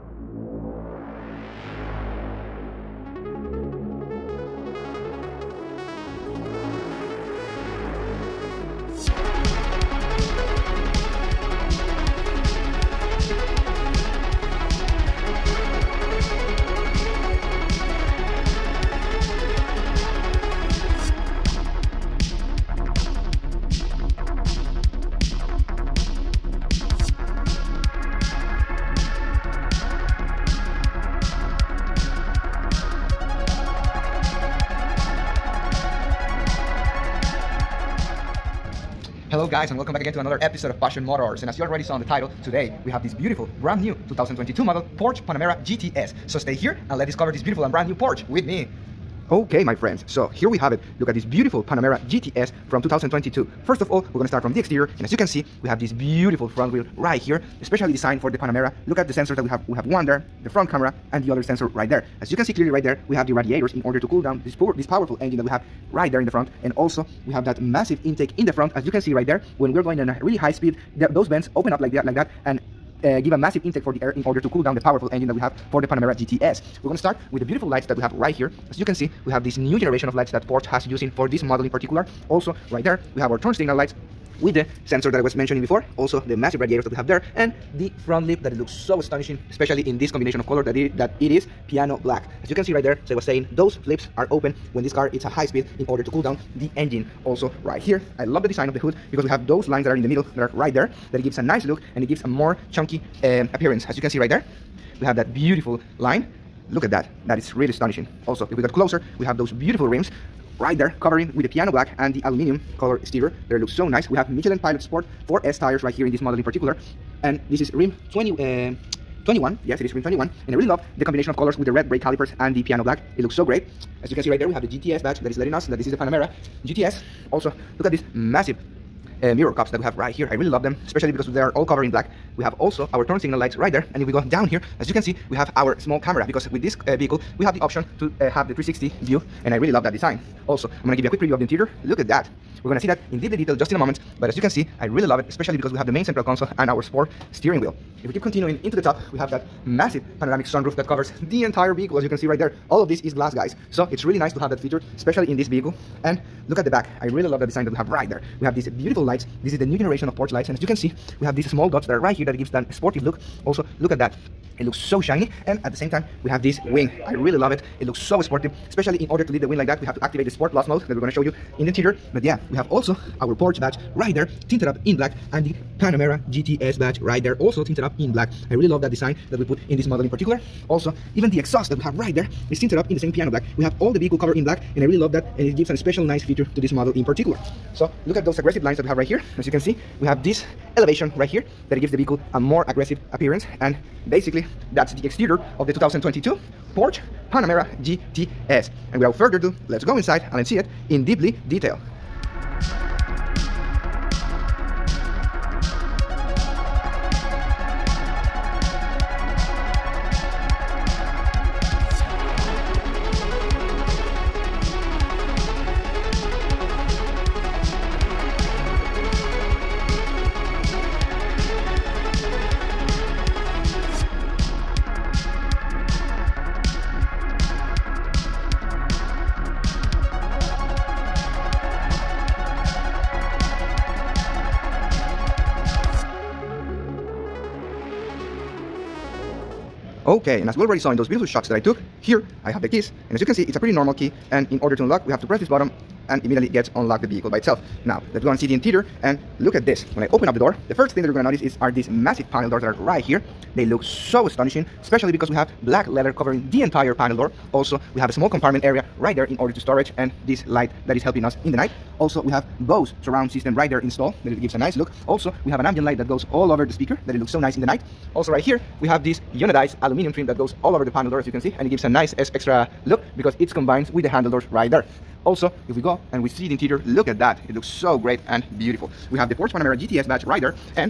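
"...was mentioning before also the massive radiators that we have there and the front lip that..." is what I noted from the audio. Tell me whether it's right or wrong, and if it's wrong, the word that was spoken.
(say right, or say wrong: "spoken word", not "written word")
right.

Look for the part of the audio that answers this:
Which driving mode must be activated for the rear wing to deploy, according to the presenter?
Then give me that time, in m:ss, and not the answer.
2:50.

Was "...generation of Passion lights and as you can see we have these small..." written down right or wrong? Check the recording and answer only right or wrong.
wrong.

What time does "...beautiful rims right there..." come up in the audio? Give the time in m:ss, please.
1:49.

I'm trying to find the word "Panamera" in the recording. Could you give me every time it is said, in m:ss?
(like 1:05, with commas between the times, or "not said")
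0:45, 0:51, 0:58, 1:15, 2:05, 2:55, 3:17, 4:39.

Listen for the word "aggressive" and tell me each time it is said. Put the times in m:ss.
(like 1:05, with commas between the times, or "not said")
3:08, 3:12.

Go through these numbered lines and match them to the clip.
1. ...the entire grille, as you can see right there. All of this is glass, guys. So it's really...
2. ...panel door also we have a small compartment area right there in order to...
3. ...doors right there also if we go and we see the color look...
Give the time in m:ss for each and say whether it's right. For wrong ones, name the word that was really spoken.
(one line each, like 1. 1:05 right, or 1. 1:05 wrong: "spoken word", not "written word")
1. 2:31 wrong: "vehicle", not "grille"
2. 4:16 right
3. 4:34 wrong: "interior", not "color".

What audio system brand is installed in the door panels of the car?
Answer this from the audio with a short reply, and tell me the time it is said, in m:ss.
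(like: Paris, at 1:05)
Bose, at 4:22.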